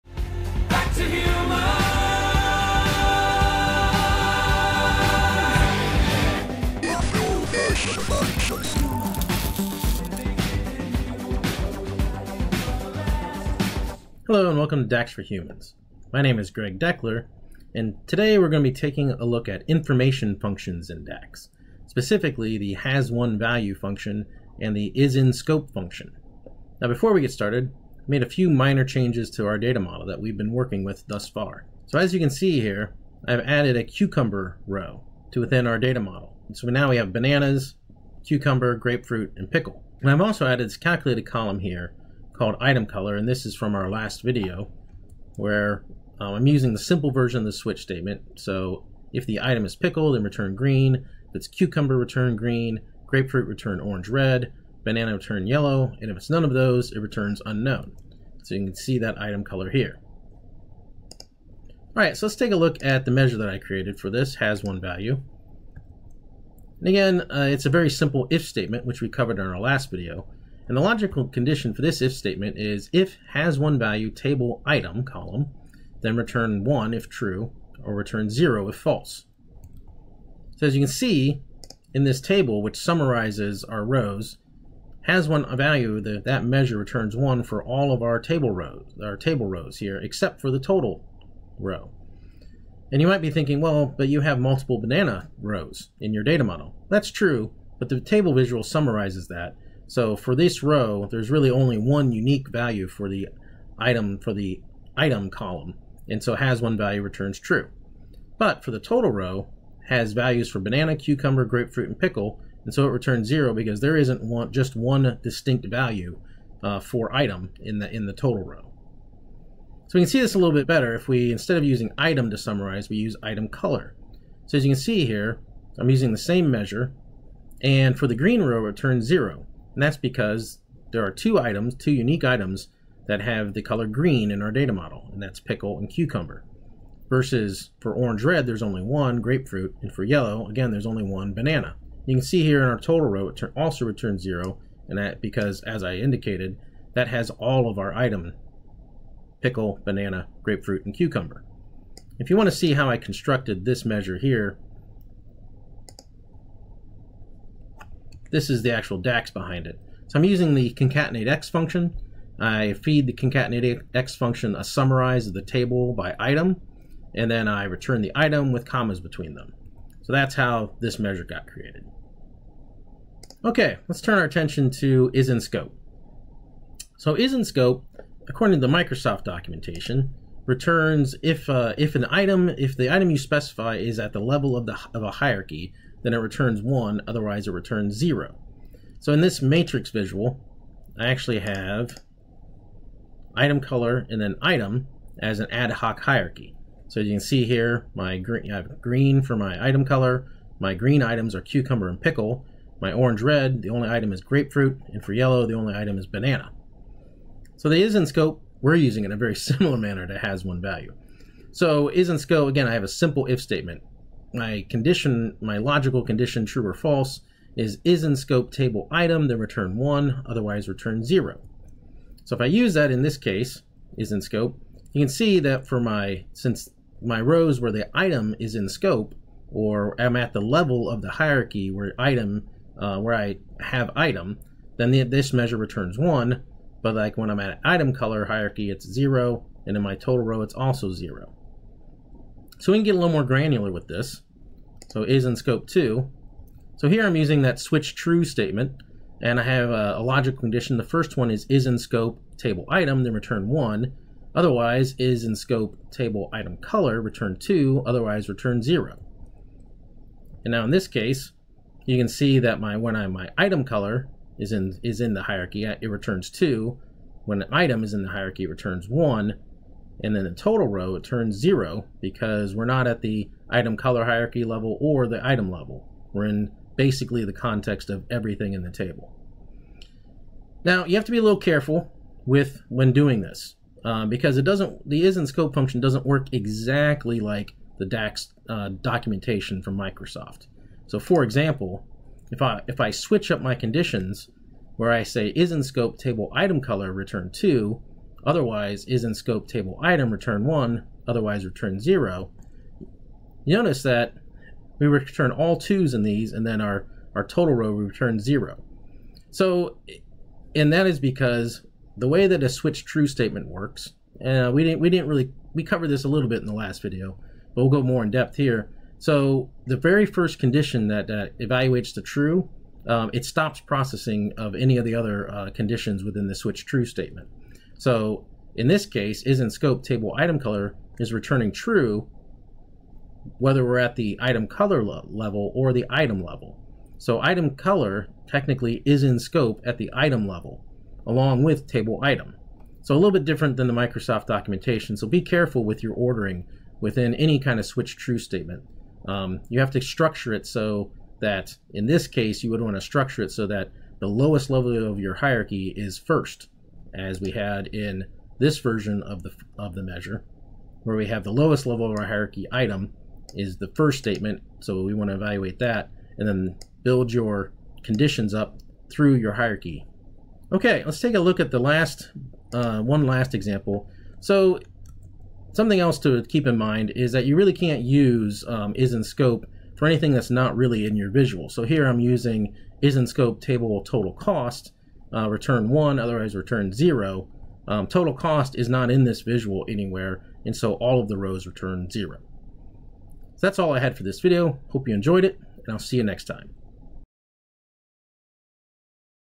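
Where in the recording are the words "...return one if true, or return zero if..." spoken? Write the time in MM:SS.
01:16.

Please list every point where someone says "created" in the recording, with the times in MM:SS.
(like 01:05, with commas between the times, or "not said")
01:03, 02:51.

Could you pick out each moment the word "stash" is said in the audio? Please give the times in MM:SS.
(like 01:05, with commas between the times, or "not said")
not said.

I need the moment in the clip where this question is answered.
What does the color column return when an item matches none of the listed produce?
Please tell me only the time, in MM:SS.
00:56.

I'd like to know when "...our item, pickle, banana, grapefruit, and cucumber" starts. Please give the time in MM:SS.
02:27.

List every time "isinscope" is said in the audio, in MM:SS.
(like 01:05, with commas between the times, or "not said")
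00:24.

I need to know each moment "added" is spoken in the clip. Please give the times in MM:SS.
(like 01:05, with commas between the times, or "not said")
00:33, 00:40.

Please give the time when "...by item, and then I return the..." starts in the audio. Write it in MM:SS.
02:45.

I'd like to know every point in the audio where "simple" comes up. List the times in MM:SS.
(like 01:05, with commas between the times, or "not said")
00:46, 01:07, 03:32.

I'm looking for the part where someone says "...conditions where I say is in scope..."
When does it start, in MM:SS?
04:53.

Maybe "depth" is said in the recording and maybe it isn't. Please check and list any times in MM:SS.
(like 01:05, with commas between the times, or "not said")
05:18.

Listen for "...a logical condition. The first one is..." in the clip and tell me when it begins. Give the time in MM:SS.
04:09.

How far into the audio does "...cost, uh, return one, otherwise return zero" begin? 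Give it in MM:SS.
06:24.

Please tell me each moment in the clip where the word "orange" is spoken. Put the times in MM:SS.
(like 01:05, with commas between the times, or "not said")
00:53, 02:17, 03:22.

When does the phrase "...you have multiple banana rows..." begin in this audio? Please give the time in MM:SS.
01:34.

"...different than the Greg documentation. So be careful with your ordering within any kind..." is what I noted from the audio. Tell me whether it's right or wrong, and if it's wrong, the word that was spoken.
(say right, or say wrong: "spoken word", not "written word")
wrong: "Microsoft", not "Greg".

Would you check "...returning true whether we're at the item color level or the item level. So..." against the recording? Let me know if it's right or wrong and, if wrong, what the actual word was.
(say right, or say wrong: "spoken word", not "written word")
right.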